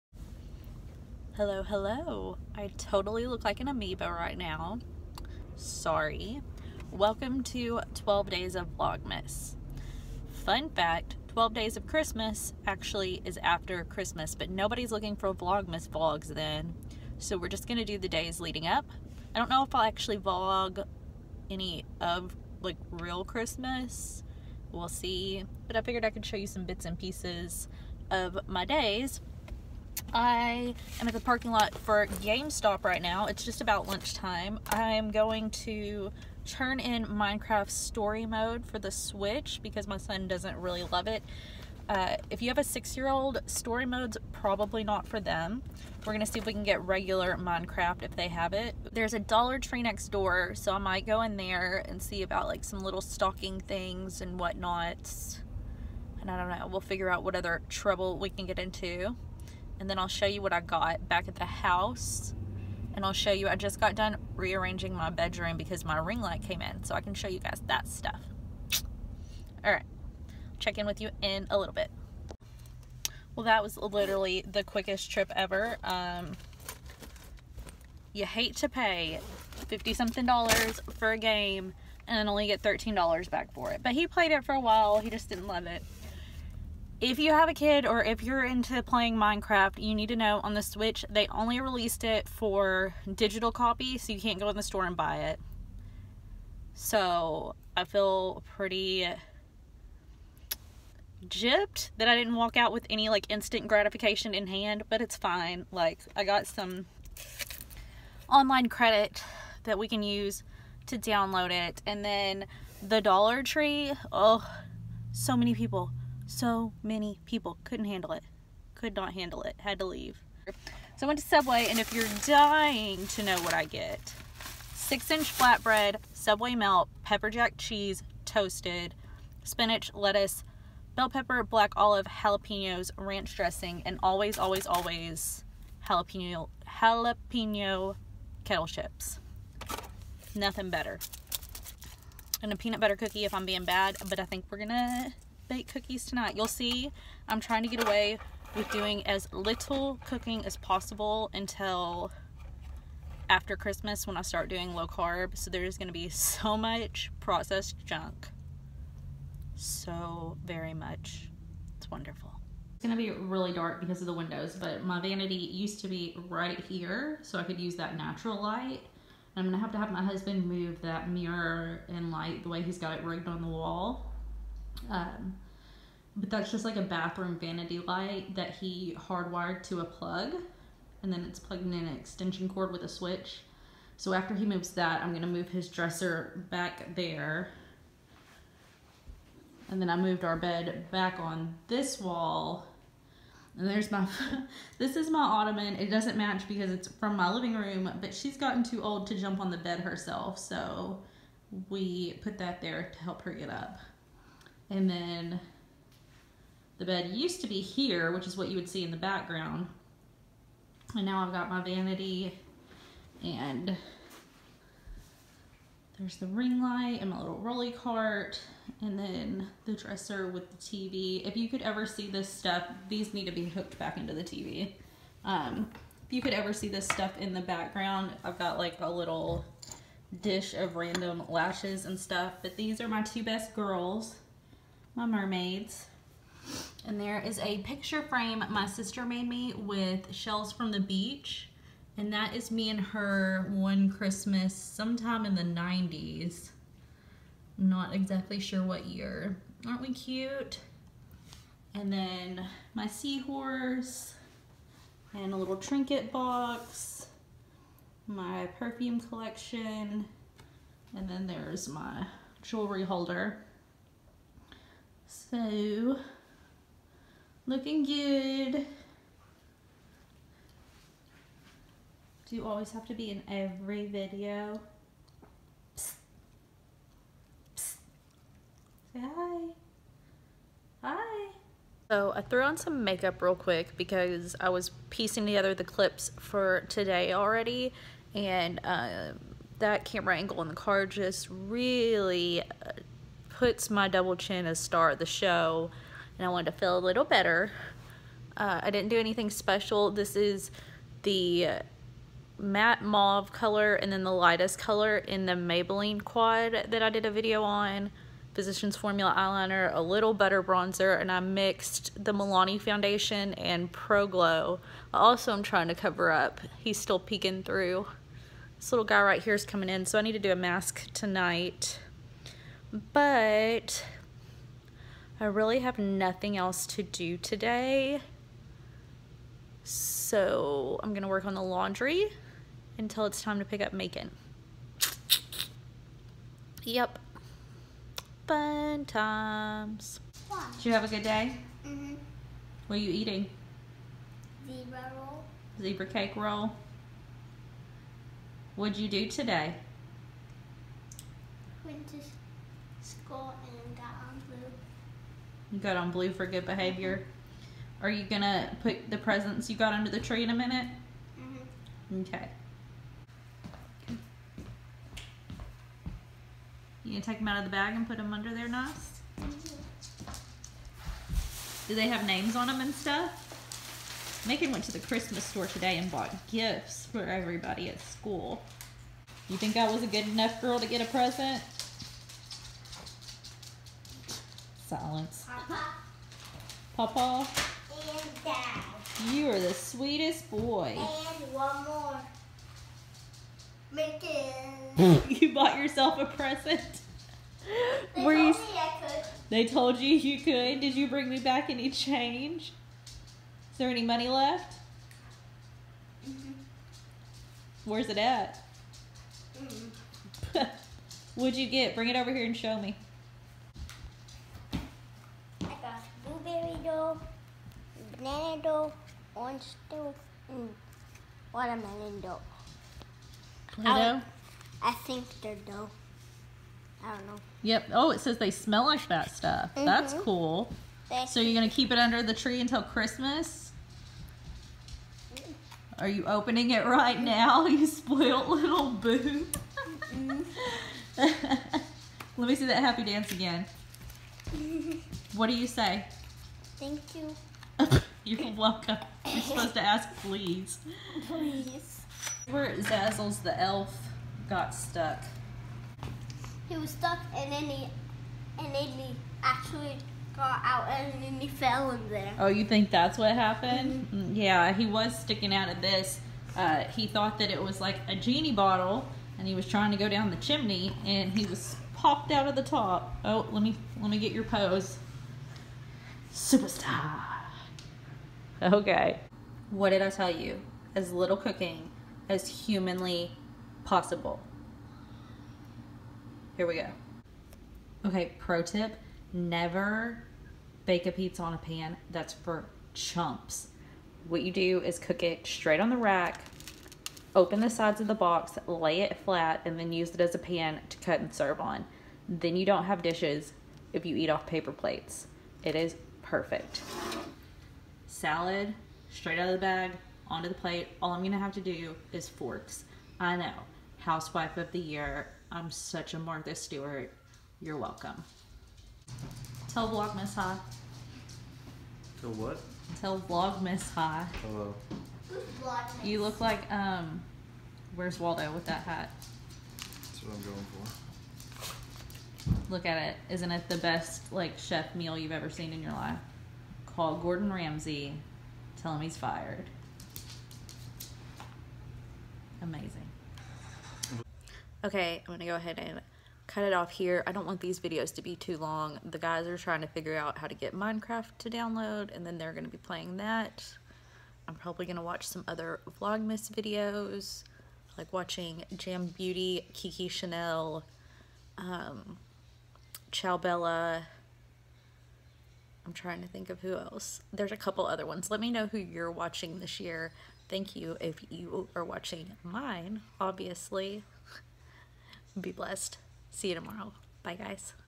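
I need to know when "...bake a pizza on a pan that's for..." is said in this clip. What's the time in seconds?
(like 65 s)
490 s.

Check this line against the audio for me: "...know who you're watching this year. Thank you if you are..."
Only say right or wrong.
right.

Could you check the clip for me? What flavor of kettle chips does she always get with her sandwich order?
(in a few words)
jalapeno.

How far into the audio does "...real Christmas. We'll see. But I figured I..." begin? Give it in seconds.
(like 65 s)
22 s.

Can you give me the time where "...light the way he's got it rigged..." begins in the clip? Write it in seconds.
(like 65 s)
172 s.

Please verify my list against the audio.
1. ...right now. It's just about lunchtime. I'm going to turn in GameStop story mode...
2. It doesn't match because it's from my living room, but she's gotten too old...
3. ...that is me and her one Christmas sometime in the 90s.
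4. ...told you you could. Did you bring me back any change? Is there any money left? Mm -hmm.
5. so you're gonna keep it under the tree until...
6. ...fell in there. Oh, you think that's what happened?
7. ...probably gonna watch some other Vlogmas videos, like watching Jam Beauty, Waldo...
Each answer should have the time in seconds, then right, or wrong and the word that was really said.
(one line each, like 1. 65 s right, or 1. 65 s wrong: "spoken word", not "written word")
1. 32 s wrong: "Minecraft", not "GameStop"
2. 195 s right
3. 242 s right
4. 399 s right
5. 431 s right
6. 461 s right
7. 554 s wrong: "Kiki", not "Waldo".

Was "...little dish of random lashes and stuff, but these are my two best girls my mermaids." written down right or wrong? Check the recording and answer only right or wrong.
right.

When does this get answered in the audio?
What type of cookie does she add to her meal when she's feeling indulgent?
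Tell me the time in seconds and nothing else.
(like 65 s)
142 s.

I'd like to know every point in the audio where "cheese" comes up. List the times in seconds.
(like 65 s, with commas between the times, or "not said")
127 s.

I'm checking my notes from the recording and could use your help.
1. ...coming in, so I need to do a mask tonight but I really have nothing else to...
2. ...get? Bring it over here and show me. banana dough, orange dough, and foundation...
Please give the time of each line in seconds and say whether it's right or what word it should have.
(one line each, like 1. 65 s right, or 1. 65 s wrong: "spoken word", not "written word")
1. 319 s right
2. 411 s wrong: "watermelon", not "foundation".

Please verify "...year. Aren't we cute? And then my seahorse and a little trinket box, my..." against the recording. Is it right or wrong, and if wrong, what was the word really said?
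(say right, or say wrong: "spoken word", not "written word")
right.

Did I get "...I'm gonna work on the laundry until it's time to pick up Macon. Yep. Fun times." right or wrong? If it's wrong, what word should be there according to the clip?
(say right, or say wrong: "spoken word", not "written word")
right.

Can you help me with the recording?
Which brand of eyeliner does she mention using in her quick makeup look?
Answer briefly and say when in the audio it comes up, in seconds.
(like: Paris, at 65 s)
Physicians Formula, at 308 s.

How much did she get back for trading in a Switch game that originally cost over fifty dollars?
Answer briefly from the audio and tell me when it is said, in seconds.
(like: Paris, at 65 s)
$13, at 82 s.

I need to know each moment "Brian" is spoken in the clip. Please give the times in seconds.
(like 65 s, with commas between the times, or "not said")
not said.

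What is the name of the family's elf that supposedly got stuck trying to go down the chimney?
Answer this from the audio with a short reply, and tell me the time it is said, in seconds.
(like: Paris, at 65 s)
Zazzles, at 452 s.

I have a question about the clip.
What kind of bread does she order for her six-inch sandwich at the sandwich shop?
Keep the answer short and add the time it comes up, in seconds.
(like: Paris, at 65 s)
flatbread, at 125 s.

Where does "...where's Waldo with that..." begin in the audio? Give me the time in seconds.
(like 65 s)
527 s.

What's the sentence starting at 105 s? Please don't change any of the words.
Like I got some online credit that we can use to download it.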